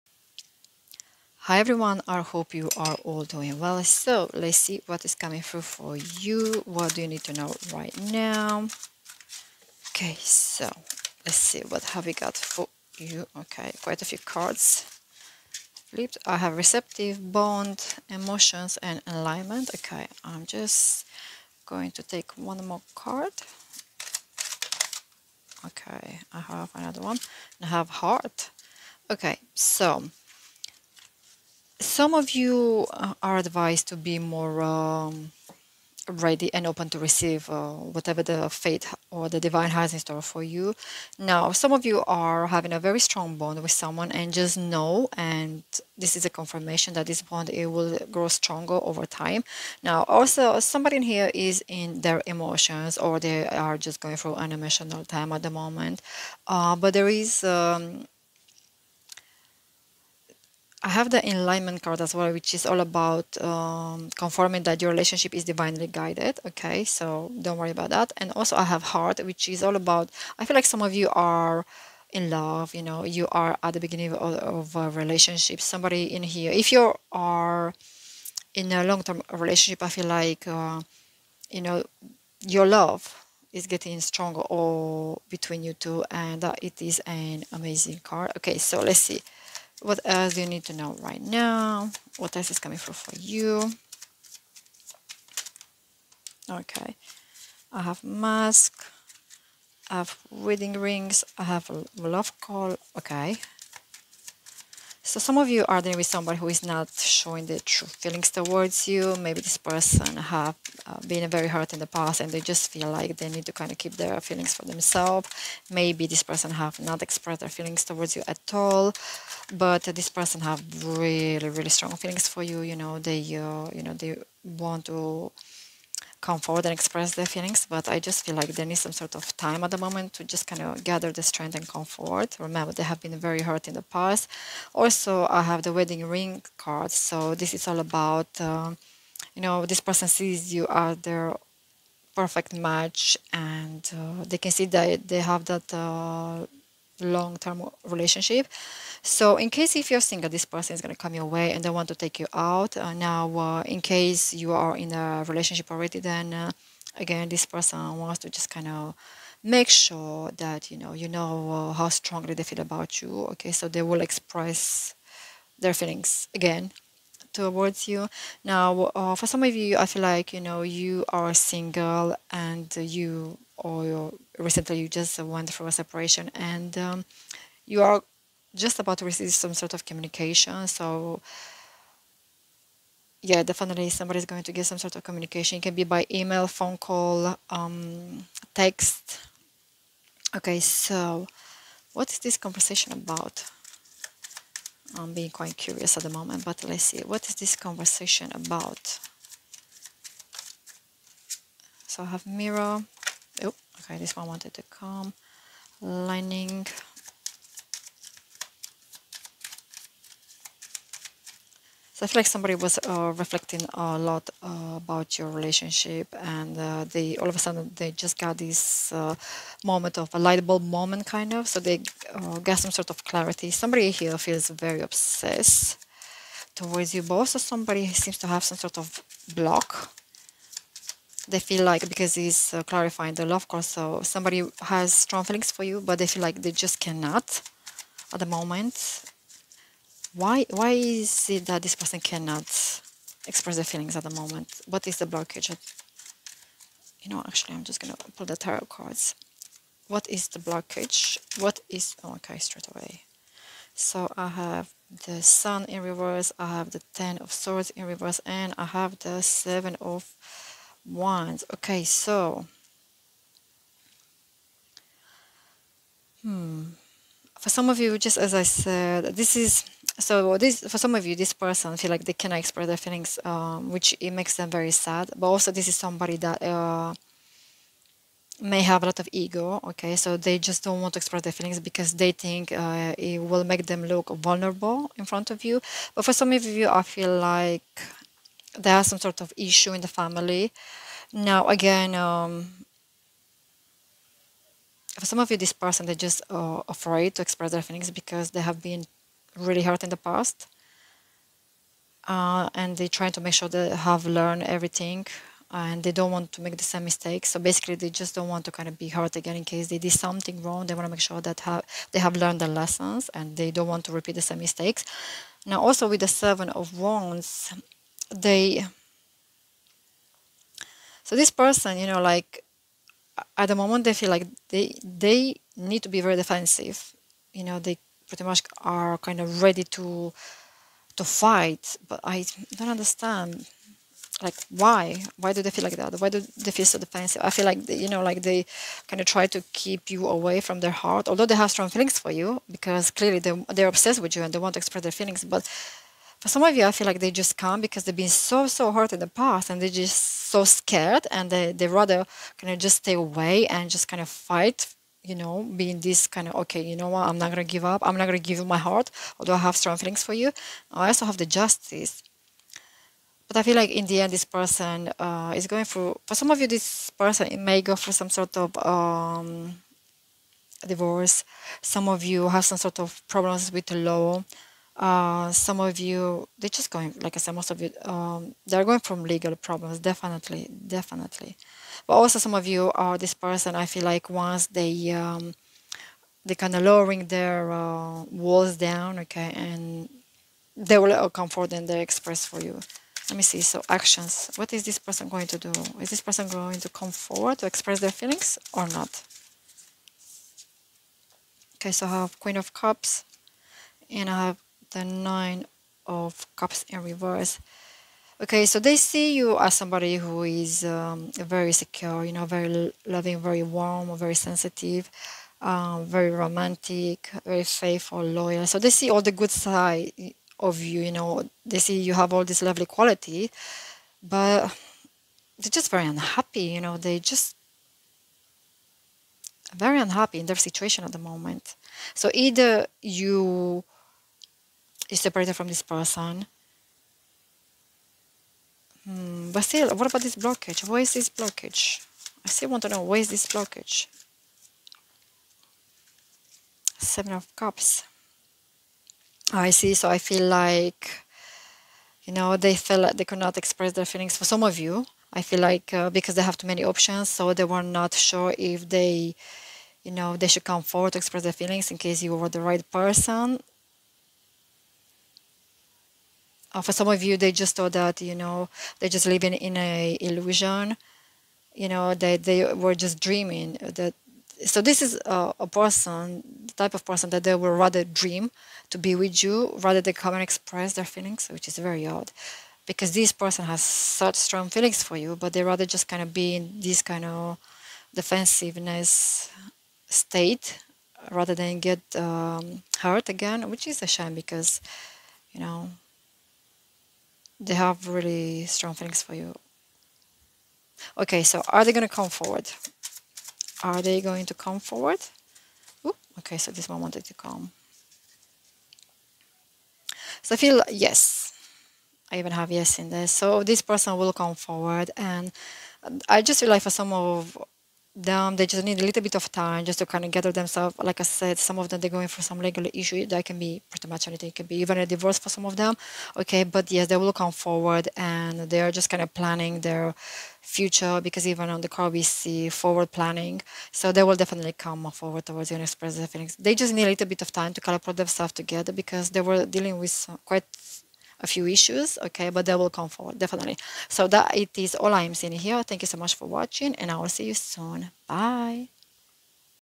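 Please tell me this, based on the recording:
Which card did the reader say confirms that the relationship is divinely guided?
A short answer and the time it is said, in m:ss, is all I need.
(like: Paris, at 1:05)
Enlightenment, at 1:01.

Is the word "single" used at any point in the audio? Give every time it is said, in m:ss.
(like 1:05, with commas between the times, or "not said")
2:30, 2:51.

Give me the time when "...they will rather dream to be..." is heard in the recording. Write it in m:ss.
7:57.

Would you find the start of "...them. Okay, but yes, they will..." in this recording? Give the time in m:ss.
8:45.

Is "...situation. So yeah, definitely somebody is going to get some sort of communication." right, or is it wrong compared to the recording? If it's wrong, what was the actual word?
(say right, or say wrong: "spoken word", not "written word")
wrong: "communication", not "situation".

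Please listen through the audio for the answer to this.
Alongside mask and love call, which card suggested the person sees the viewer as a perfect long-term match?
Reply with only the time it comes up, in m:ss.
1:40.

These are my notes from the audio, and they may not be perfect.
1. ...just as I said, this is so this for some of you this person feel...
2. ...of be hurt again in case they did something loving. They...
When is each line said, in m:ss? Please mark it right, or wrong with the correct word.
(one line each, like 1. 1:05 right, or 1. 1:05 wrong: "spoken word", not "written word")
1. 4:27 right
2. 5:08 wrong: "wrong", not "loving".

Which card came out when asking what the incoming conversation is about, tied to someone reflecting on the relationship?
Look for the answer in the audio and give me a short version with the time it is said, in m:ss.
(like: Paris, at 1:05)
Mirror, at 3:22.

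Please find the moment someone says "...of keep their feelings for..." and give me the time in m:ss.
1:53.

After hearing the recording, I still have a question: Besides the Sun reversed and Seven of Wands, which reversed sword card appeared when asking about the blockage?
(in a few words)
Ten of Swords.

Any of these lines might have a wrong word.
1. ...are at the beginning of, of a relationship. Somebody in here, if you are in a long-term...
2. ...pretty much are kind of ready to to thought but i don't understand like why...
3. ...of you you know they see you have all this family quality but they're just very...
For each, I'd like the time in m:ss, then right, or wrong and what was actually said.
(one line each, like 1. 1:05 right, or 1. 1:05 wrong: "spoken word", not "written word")
1. 1:13 right
2. 5:28 wrong: "fight", not "thought"
3. 7:00 wrong: "lovely", not "family".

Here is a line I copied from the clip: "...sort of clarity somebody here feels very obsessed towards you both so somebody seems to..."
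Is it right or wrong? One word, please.
right.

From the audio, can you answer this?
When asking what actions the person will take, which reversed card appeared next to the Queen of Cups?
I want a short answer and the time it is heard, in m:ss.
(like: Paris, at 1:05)
Nine of Cups, at 6:44.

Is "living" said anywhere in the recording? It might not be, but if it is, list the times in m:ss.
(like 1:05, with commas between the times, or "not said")
7:49.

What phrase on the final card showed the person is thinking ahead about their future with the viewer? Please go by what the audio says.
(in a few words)
Forward planning.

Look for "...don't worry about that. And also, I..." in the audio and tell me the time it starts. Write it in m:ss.
1:07.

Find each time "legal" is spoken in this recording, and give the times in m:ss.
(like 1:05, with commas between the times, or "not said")
6:19, 8:42.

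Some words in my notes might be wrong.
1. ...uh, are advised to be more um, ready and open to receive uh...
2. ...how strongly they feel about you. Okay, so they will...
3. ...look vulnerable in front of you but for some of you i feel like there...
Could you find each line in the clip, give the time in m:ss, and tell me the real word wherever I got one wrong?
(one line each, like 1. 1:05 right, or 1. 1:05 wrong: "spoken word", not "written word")
1. 0:32 right
2. 2:41 right
3. 4:43 right.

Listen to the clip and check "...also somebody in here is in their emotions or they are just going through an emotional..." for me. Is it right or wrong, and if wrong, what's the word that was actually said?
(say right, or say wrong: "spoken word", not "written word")
right.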